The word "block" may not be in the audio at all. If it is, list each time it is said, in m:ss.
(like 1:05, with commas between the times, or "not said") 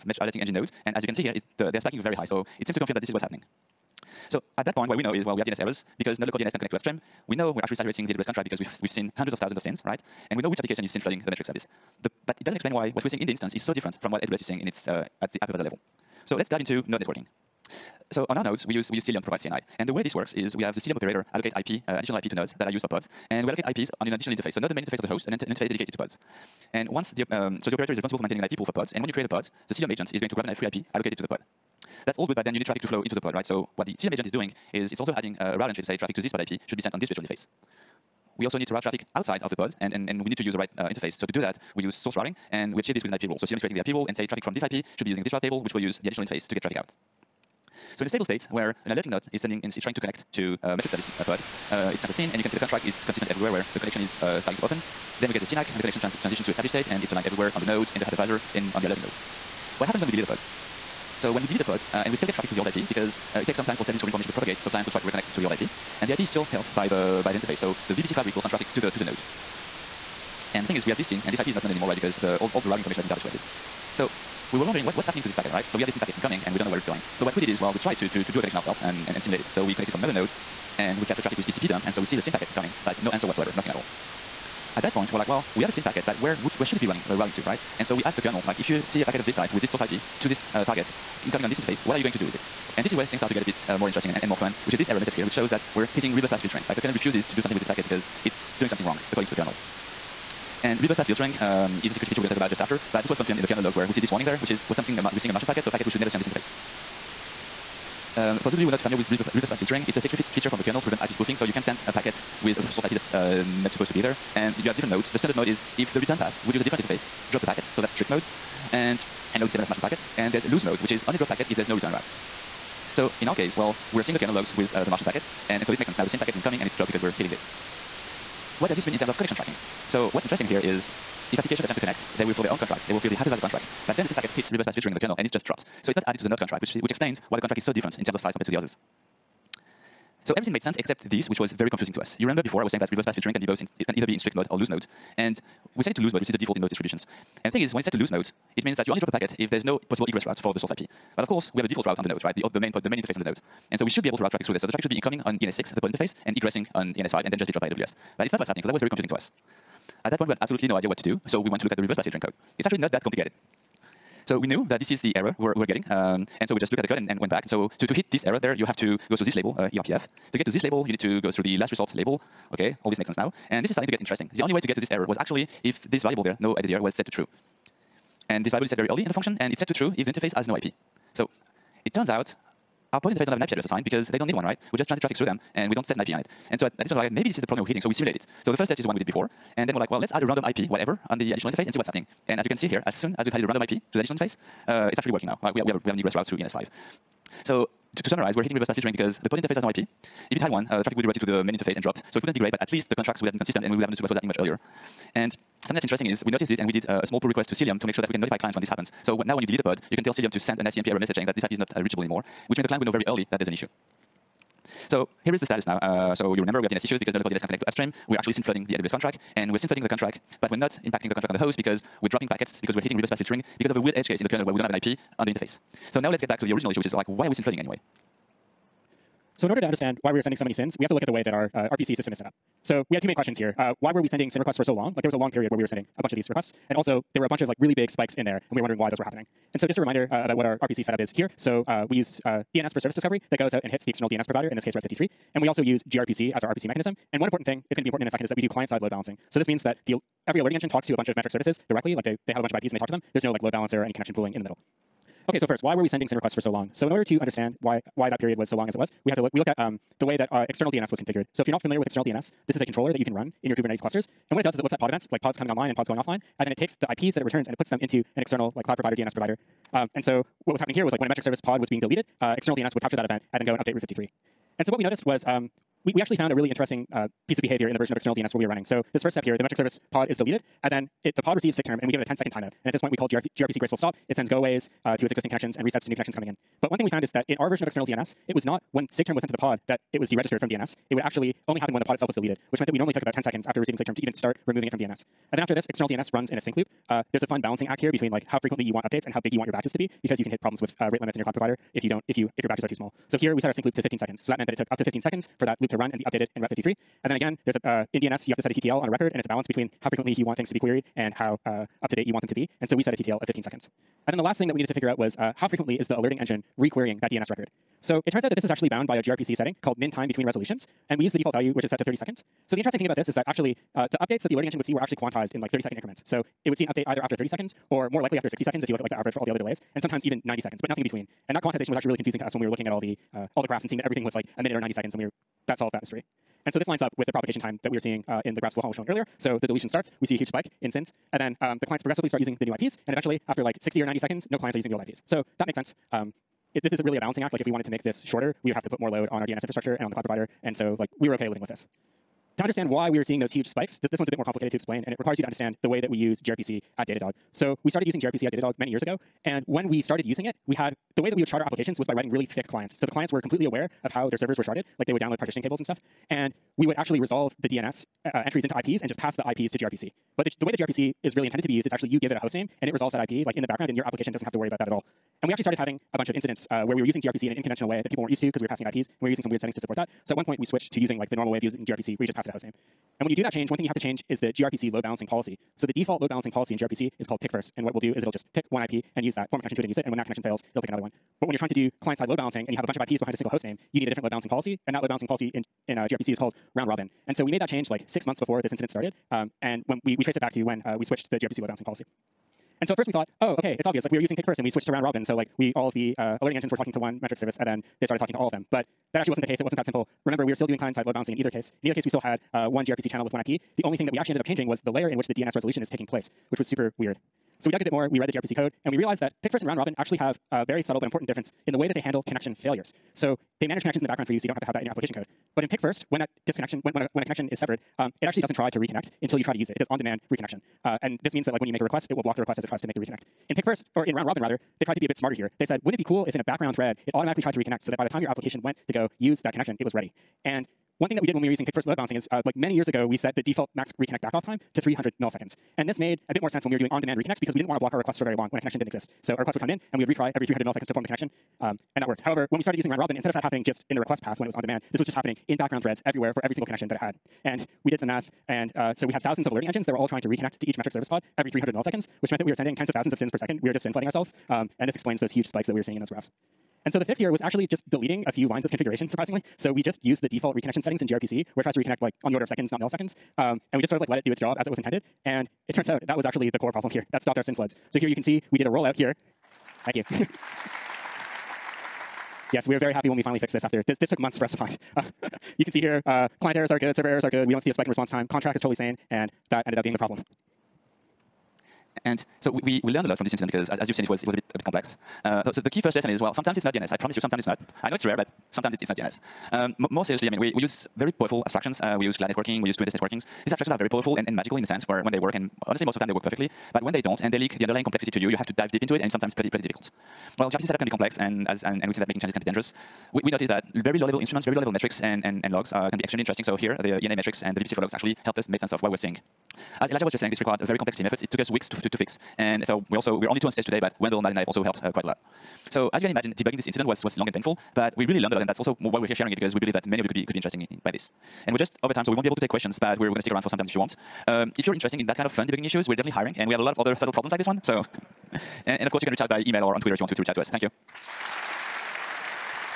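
7:12, 7:27.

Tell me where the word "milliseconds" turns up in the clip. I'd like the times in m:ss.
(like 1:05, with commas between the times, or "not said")
7:24, 7:30, 7:41, 7:52.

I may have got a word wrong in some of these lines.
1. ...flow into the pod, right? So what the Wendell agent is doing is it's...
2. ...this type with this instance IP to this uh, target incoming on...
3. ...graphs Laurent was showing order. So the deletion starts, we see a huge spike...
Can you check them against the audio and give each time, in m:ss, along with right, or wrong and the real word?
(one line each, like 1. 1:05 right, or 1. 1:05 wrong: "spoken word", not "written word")
1. 0:32 wrong: "Cilium", not "Wendell"
2. 1:29 wrong: "source", not "instance"
3. 5:38 wrong: "earlier", not "order".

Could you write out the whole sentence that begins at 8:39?
As Elijah was just saying, this required very complex team efforts.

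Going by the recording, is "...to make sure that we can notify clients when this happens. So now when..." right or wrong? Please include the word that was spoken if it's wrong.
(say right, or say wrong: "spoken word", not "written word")
right.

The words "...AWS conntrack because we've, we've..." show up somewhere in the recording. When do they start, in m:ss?
0:08.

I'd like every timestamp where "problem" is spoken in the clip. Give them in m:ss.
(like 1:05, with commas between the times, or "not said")
3:07, 5:00, 7:56, 8:09, 8:56.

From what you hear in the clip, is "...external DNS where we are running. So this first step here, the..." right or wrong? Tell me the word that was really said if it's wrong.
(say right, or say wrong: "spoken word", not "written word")
right.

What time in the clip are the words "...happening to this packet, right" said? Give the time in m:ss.
1:15.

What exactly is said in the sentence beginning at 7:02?
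So they manage connections in the background for you, so you don't have to have that in your application code.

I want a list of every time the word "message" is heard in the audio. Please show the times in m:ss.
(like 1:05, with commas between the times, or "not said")
1:34, 3:30.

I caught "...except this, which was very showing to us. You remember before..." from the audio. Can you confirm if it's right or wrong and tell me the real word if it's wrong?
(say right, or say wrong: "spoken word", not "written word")
wrong: "confusing", not "showing".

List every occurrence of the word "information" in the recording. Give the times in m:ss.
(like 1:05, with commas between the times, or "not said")
1:04, 1:12.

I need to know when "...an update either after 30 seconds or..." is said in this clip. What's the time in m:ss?
5:26.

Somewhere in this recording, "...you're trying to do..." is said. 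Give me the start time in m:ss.
6:31.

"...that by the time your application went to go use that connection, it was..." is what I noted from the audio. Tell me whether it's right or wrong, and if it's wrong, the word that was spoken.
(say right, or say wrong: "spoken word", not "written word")
right.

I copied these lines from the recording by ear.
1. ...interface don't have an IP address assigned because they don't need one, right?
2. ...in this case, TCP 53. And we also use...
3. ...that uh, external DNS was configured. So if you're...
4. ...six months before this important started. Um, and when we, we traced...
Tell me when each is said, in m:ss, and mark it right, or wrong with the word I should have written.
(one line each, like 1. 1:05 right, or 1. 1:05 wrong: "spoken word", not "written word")
1. 3:03 right
2. 4:04 wrong: "Route", not "TCP"
3. 4:20 right
4. 6:37 wrong: "incident", not "important".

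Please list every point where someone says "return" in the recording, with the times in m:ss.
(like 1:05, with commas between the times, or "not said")
1:55, 2:01, 4:27.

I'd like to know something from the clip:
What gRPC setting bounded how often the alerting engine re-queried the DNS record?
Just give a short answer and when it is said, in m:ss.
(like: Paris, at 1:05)
min time between resolutions, at 5:19.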